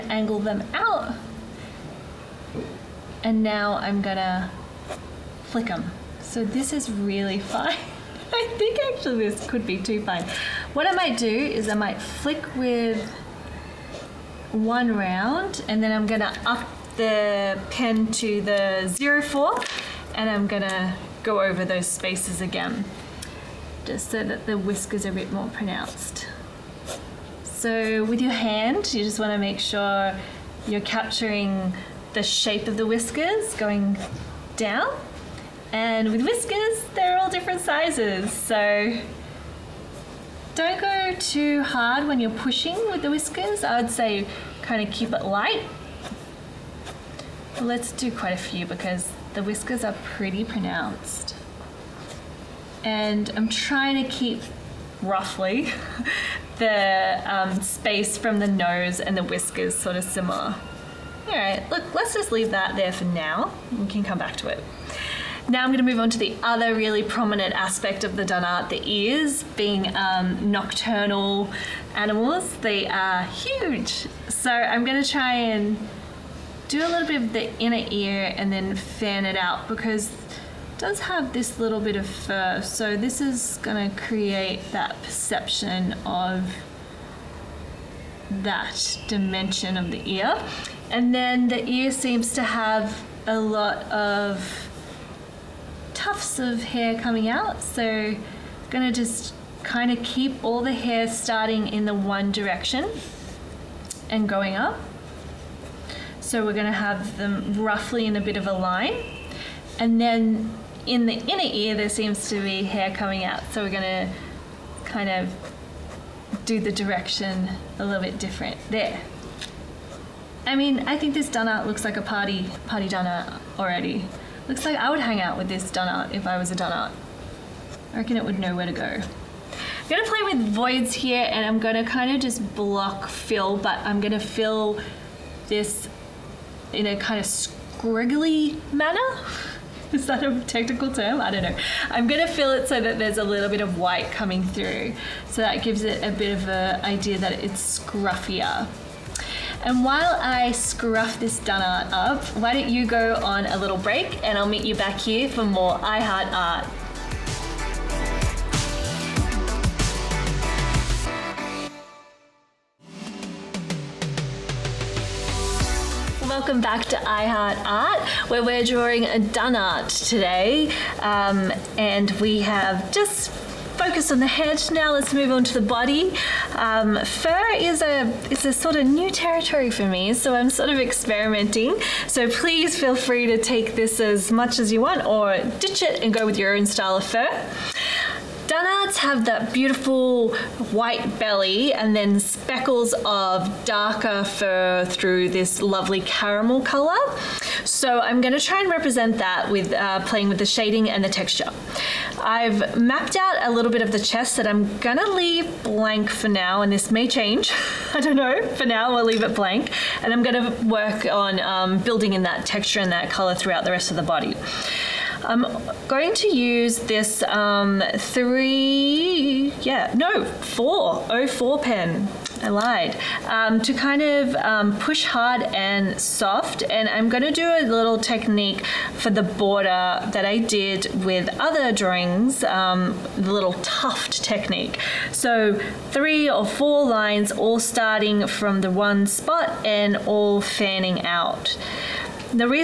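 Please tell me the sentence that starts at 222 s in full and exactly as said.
I lied, um, to kind of um, push hard and soft.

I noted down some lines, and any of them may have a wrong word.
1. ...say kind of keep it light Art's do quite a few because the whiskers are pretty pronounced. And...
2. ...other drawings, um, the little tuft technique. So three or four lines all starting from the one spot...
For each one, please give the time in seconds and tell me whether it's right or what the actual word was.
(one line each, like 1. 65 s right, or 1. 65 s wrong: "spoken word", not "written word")
1. 43 s wrong: "Let", not "Art"
2. 231 s right.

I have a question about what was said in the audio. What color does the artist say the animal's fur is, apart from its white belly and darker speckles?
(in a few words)
caramel.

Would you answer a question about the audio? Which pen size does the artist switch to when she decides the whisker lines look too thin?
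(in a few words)
04.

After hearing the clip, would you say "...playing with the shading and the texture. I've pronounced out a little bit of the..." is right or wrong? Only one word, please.
wrong.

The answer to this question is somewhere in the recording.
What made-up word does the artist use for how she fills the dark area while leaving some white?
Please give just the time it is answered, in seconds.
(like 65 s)
137 s.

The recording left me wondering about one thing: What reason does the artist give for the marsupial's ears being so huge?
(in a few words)
nocturnal animals.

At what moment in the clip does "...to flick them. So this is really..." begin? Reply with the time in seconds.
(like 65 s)
4 s.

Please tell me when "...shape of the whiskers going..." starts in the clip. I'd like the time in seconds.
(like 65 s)
32 s.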